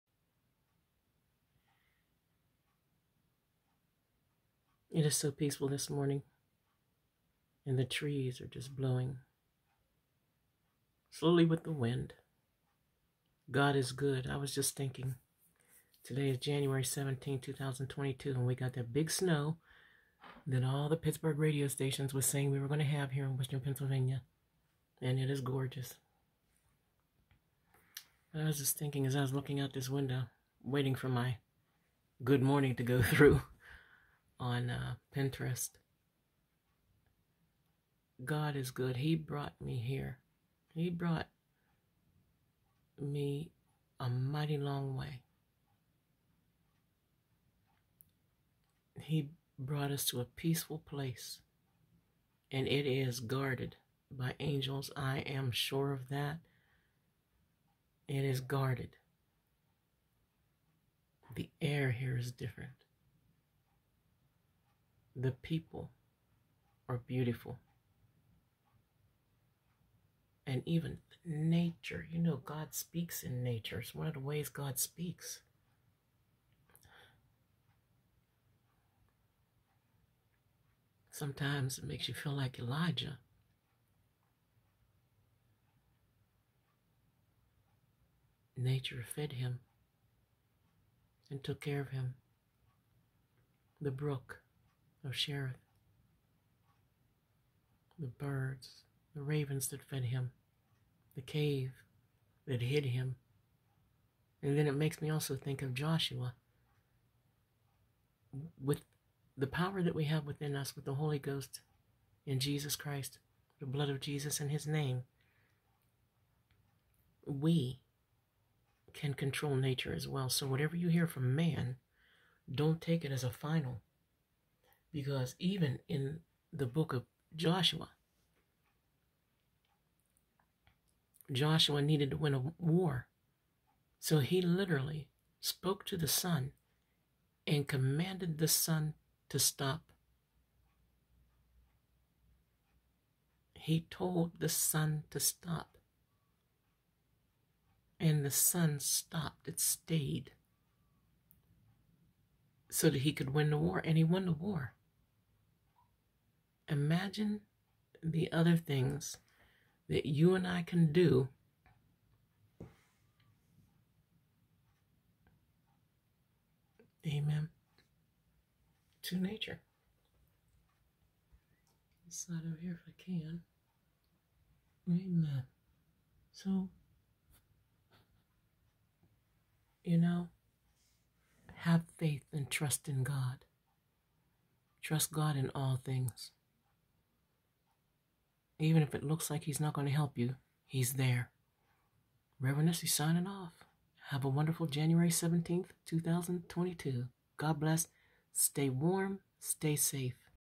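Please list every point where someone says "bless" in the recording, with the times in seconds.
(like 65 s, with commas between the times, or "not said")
197 s.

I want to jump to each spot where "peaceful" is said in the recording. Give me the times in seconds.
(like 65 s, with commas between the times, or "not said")
5 s, 50 s.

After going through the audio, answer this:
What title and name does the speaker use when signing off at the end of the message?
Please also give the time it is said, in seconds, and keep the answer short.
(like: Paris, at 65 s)
Reverend Essie, at 192 s.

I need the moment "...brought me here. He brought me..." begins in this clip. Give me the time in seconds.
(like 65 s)
39 s.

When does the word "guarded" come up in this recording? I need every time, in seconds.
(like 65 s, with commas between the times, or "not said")
53 s, 58 s.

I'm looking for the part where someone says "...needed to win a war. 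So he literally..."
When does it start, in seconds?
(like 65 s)
131 s.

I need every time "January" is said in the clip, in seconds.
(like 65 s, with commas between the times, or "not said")
16 s, 194 s.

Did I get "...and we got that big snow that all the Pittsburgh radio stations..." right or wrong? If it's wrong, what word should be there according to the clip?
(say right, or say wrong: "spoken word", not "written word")
right.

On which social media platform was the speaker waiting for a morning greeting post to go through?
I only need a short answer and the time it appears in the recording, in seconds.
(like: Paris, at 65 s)
Pinterest, at 35 s.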